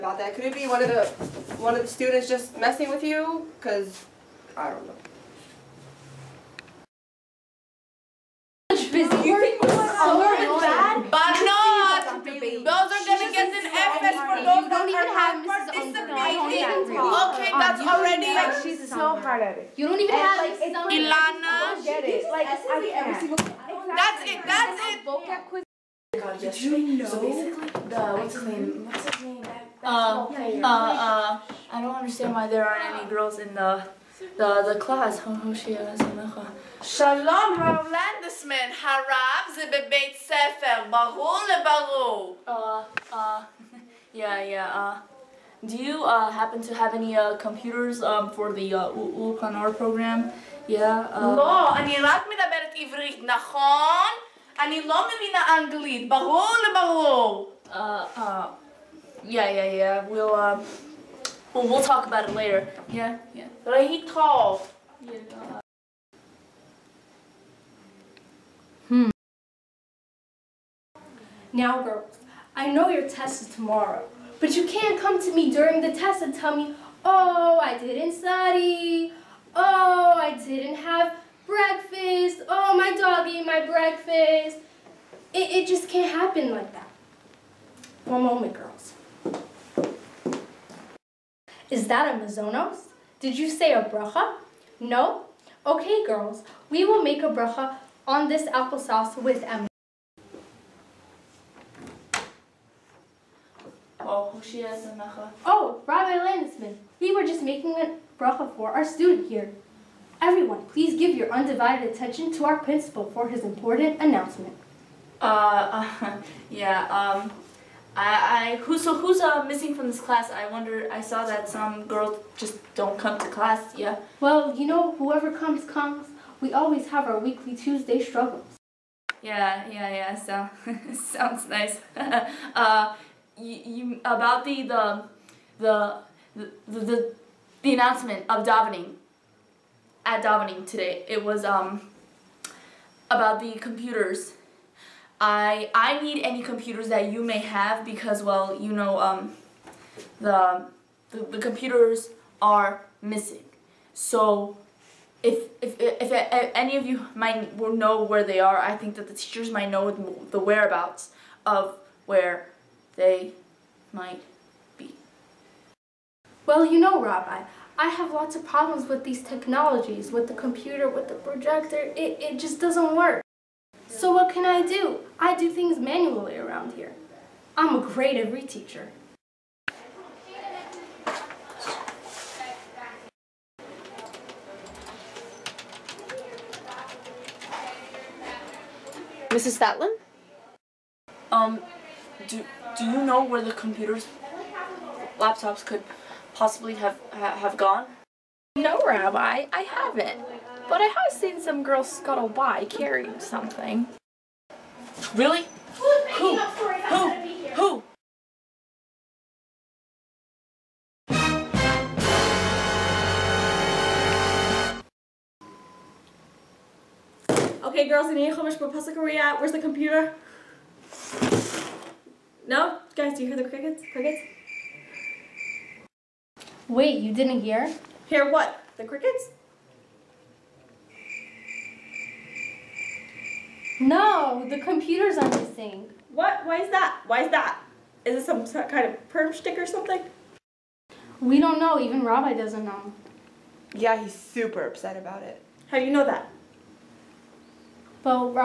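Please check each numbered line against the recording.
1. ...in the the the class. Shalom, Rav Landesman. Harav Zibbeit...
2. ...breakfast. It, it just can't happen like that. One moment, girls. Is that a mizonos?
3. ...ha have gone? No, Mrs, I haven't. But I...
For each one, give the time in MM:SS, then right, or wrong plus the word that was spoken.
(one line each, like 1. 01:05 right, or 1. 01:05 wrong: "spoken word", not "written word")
1. 00:33 right
2. 01:23 right
3. 03:17 wrong: "Rabbi", not "Mrs".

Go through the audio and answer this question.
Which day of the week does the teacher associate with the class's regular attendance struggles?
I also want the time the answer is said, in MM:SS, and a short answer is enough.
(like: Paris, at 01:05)
Tuesday, at 02:07.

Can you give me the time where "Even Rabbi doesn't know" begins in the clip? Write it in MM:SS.
04:01.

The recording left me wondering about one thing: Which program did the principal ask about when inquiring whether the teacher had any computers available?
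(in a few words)
Ulkanor.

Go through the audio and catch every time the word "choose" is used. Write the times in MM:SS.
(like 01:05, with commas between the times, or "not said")
not said.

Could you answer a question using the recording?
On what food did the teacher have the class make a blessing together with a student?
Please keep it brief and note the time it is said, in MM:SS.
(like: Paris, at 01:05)
applesauce, at 01:38.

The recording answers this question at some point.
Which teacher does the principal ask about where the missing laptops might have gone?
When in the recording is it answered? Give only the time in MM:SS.
03:09.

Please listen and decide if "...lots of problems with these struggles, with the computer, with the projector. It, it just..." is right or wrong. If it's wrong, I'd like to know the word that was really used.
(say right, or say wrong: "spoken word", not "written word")
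wrong: "technologies", not "struggles".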